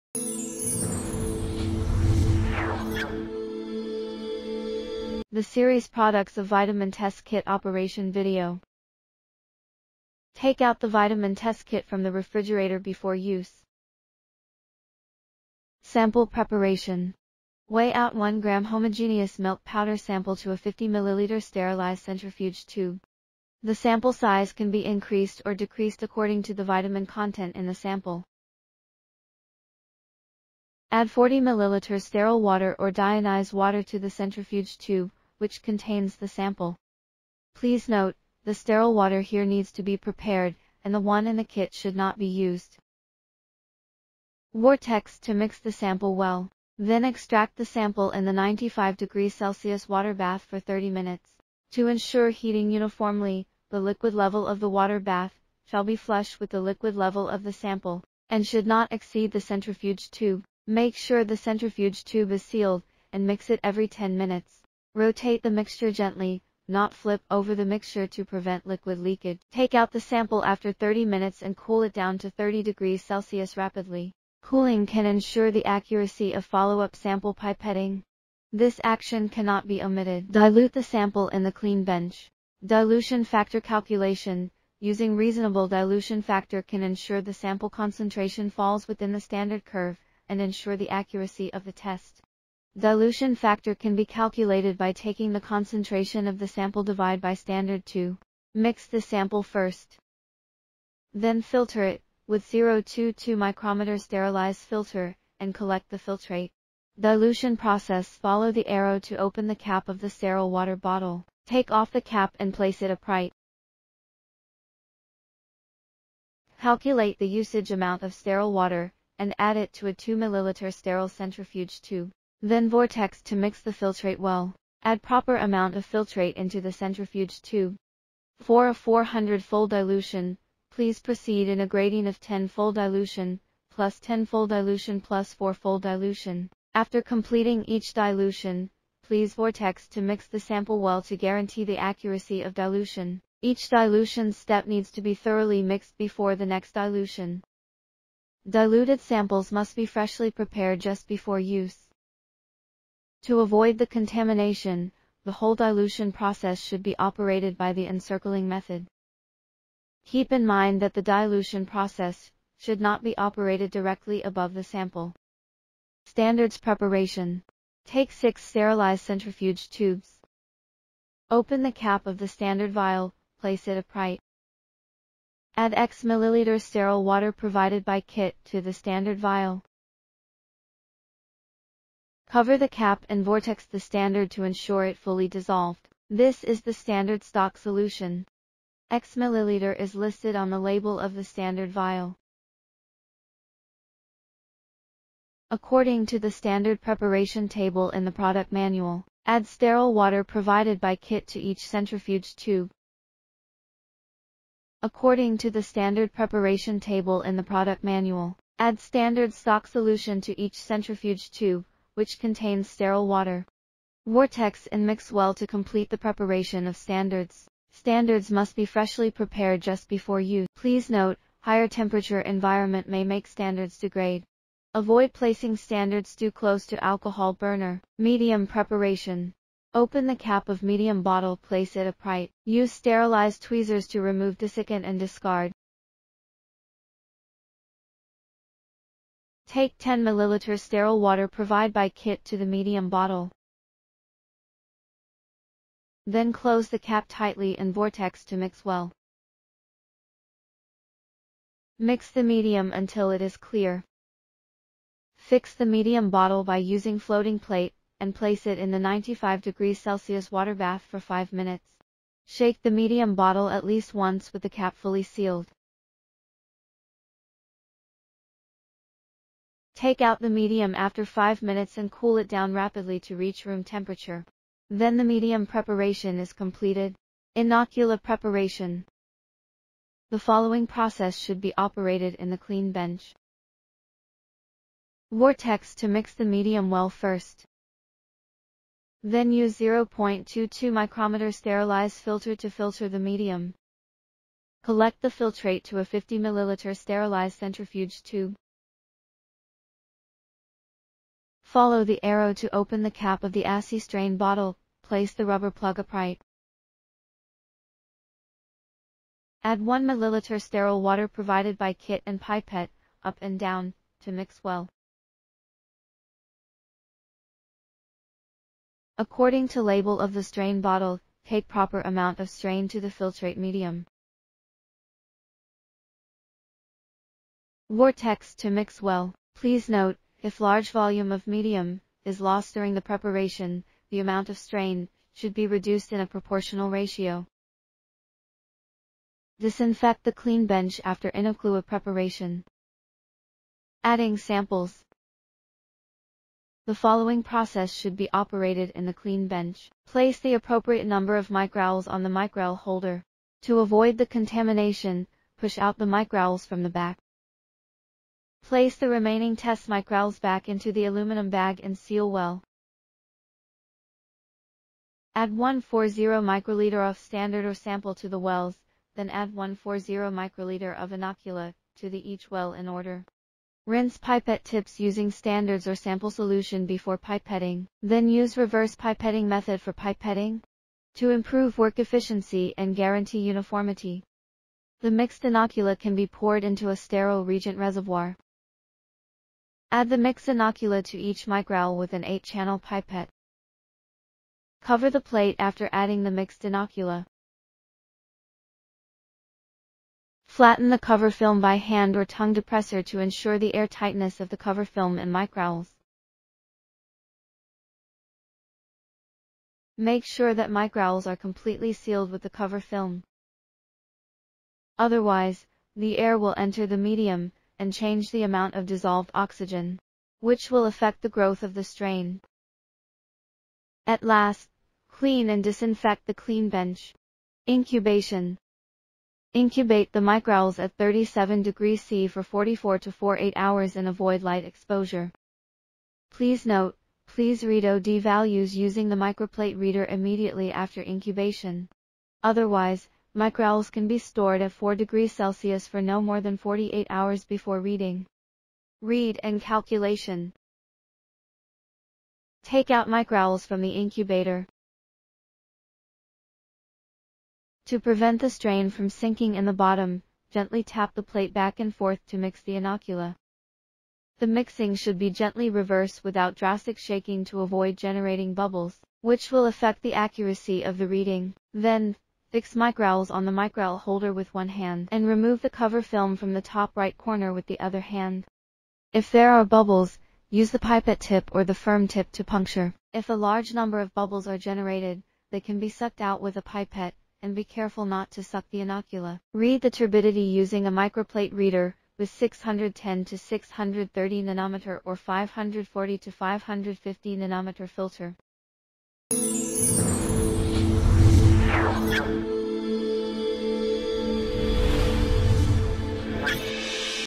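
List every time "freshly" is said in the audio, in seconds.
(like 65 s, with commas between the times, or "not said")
149 s, 218 s.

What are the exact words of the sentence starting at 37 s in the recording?
Please note, the sterile water here needs to be prepared, and the one in the kit should not be used.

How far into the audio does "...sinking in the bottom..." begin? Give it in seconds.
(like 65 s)
458 s.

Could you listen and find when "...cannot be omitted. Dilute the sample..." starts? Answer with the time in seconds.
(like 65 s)
79 s.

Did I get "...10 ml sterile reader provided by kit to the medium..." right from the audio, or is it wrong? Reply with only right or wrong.
wrong.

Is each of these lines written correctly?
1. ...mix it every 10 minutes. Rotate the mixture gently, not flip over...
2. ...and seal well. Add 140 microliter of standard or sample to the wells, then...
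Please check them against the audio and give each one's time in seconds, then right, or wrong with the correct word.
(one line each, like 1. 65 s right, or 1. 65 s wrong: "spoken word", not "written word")
1. 63 s right
2. 361 s right.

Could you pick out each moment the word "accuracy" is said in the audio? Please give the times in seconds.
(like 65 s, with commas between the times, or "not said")
75 s, 90 s, 141 s, 469 s.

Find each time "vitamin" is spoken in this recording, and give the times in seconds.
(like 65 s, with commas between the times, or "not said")
6 s, 10 s, 26 s.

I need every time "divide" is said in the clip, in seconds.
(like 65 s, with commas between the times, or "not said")
96 s.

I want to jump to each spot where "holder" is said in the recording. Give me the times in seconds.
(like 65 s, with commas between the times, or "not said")
352 s, 473 s.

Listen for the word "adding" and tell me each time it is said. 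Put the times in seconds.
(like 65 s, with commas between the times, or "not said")
343 s, 395 s.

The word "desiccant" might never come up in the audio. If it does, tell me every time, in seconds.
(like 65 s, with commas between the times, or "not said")
234 s.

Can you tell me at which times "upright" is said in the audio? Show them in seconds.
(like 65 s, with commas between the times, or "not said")
112 s, 173 s, 231 s, 305 s.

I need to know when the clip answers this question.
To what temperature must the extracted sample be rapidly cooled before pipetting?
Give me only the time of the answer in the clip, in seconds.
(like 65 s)
72 s.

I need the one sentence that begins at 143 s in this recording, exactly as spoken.
Each dilution step needs to be thoroughly mixed before the next dilution.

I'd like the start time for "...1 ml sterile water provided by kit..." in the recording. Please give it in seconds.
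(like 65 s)
309 s.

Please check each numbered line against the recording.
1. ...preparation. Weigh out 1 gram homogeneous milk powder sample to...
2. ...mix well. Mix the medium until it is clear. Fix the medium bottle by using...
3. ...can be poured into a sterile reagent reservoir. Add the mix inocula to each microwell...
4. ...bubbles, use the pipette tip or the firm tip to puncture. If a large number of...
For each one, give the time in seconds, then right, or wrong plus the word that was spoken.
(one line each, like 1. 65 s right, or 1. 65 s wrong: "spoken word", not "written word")
1. 16 s right
2. 248 s right
3. 385 s right
4. 479 s right.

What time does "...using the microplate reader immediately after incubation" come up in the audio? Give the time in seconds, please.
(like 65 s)
438 s.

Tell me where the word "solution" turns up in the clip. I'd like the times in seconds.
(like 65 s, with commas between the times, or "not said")
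187 s, 209 s, 376 s.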